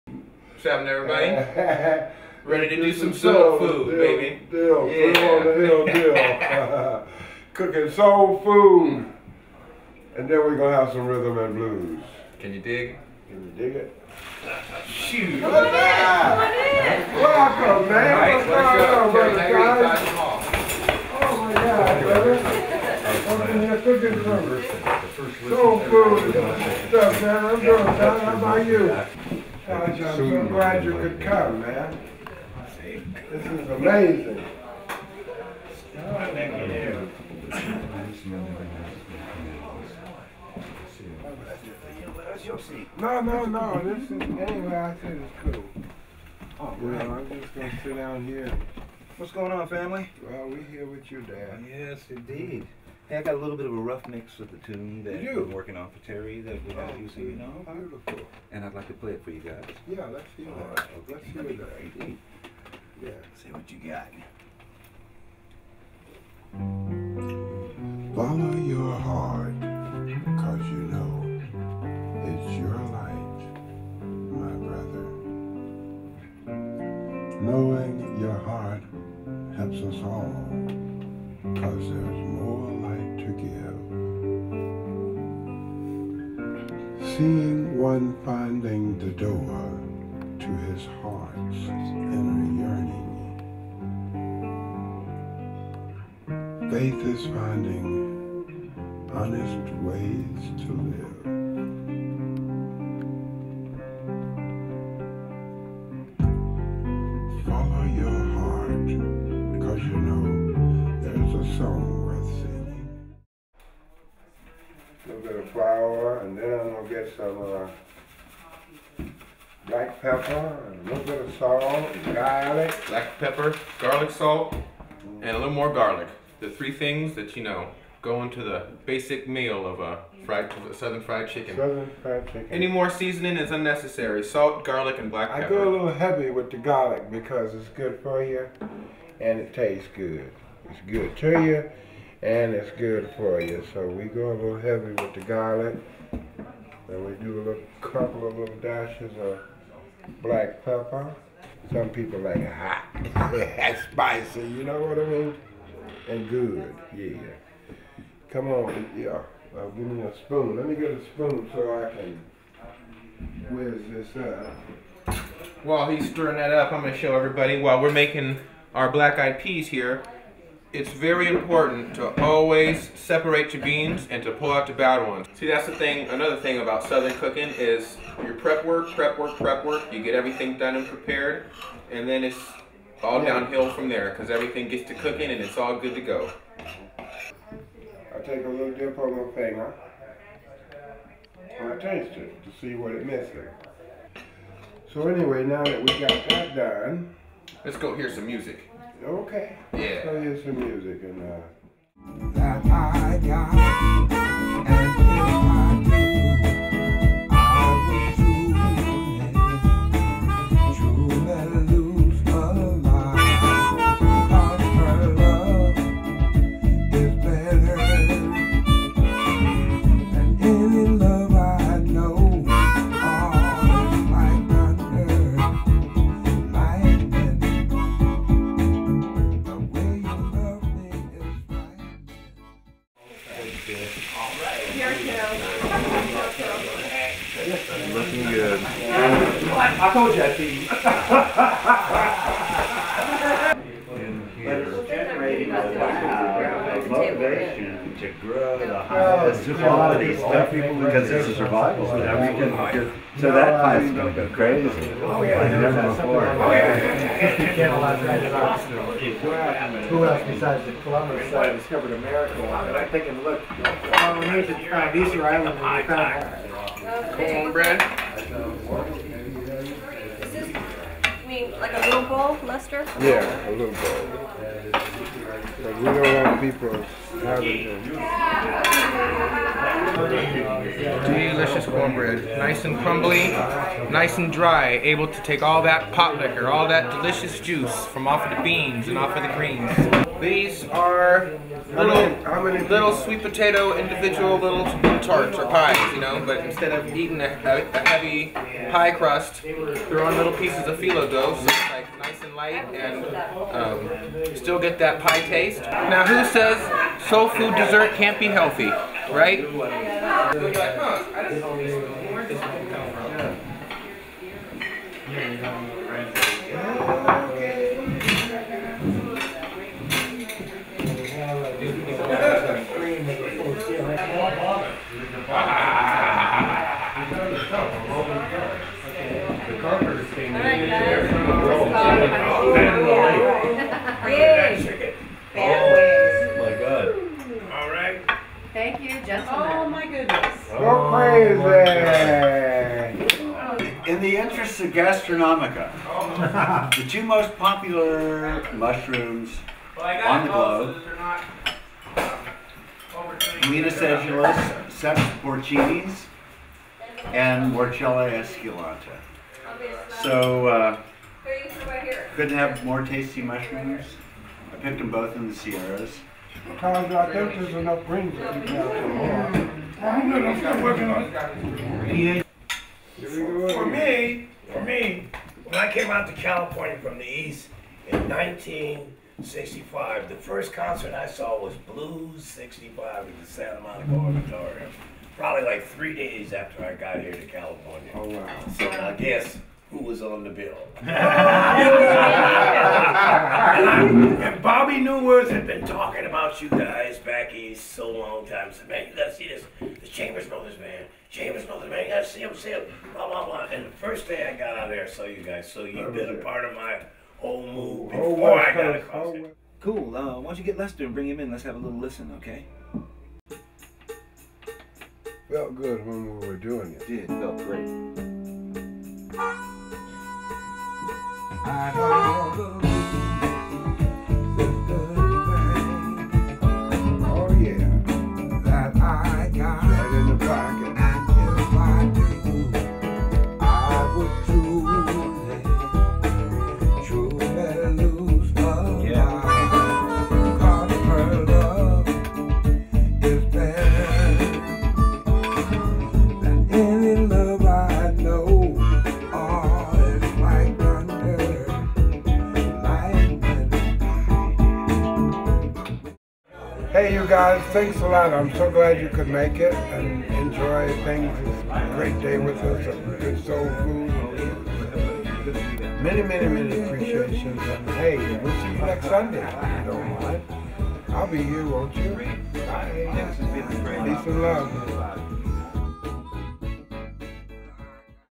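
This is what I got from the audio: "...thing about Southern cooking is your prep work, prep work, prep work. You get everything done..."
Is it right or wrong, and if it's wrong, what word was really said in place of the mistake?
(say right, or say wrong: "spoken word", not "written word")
right.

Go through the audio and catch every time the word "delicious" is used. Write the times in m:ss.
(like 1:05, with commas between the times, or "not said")
4:41, 4:46.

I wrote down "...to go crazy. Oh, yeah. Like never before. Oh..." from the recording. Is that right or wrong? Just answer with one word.
right.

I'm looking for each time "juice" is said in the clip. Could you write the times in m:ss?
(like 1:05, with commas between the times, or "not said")
4:47.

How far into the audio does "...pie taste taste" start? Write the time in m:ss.
5:05.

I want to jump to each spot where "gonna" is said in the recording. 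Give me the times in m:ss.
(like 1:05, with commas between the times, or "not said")
0:47, 1:56, 2:46.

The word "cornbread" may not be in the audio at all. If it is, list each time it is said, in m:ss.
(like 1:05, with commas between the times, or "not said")
4:27, 4:41.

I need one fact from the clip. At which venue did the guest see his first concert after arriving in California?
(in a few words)
Santa Monica Auditorium.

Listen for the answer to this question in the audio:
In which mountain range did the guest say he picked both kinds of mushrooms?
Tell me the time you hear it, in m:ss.
6:05.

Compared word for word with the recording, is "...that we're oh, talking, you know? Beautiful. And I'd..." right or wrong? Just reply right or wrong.
wrong.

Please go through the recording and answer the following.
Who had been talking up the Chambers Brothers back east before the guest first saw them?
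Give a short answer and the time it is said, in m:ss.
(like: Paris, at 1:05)
Bobby Neuwirth, at 6:34.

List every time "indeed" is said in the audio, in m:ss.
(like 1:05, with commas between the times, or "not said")
0:52.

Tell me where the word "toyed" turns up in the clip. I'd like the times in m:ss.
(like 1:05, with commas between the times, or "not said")
not said.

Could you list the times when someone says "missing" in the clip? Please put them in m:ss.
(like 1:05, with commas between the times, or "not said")
3:13.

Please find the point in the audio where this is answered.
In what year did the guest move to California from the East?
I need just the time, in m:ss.
6:18.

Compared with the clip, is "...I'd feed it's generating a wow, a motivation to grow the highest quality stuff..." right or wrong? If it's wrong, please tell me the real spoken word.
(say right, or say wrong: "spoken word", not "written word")
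right.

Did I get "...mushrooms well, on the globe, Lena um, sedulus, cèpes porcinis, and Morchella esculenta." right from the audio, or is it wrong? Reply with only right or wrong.
right.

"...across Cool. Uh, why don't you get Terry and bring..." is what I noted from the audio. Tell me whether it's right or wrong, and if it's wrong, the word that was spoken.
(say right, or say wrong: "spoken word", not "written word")
wrong: "Lester", not "Terry".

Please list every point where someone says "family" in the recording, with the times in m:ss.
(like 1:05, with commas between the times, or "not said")
0:49.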